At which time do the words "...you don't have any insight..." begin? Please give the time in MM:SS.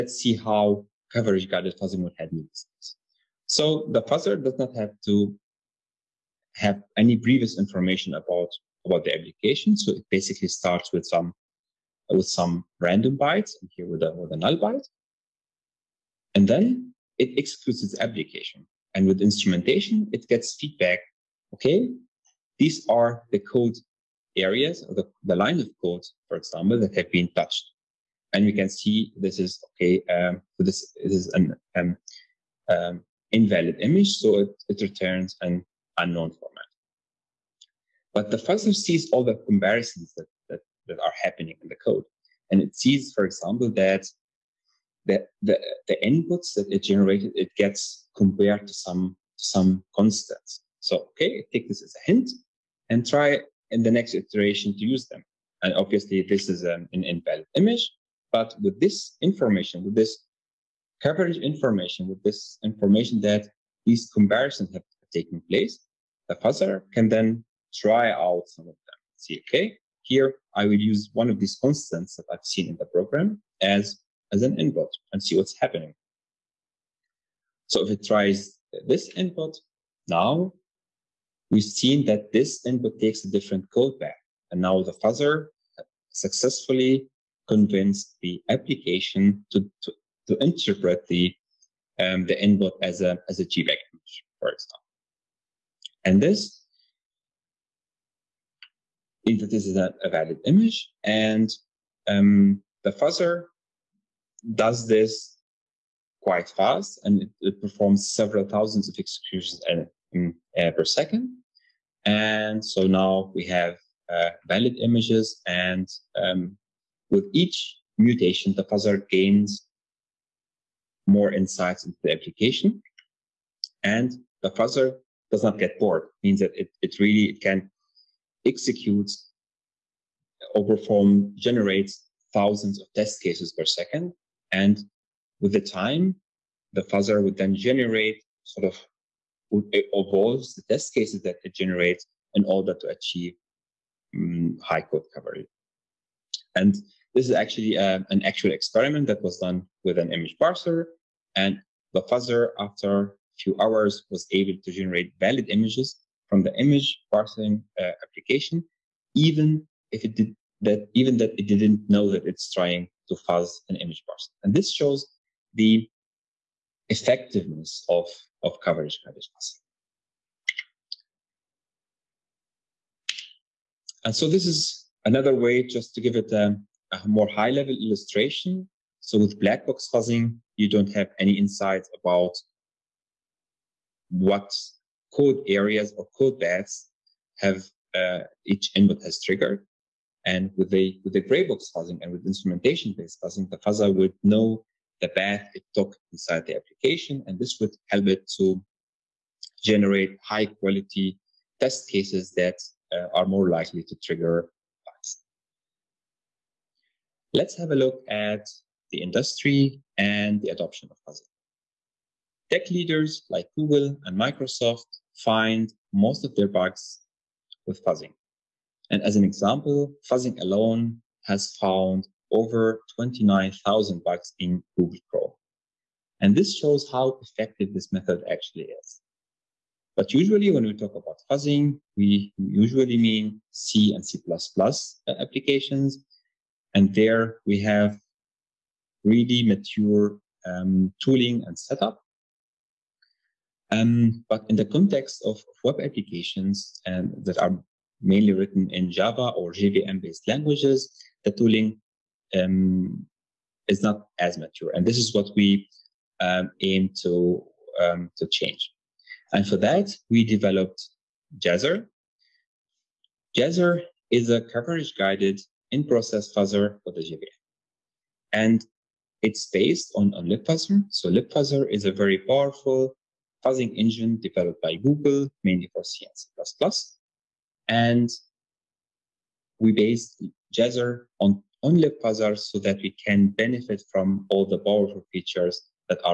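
03:00.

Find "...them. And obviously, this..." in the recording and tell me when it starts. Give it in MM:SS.
00:55.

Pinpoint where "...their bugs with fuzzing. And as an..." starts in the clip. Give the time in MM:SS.
03:36.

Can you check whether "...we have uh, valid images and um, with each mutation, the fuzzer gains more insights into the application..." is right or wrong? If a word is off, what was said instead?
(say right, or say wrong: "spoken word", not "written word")
right.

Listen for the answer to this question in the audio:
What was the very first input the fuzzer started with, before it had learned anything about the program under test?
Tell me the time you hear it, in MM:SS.
00:14.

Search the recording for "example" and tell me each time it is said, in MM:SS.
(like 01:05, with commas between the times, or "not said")
00:26, 00:43, 01:34, 03:39.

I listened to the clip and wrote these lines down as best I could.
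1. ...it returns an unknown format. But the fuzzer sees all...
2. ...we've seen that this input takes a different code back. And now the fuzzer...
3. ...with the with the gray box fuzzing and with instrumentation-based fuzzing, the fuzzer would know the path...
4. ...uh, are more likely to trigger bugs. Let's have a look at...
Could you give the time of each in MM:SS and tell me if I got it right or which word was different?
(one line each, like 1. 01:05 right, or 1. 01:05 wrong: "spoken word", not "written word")
1. 00:34 right
2. 01:21 right
3. 03:10 right
4. 03:22 right.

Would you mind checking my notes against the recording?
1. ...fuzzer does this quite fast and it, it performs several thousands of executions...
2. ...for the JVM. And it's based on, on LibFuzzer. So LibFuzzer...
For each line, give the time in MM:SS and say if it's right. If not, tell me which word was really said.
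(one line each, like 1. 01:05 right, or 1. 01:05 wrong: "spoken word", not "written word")
1. 01:42 right
2. 04:26 right.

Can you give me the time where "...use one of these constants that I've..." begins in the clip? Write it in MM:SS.
01:10.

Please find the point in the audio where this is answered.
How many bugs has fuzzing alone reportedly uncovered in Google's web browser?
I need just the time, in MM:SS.
03:42.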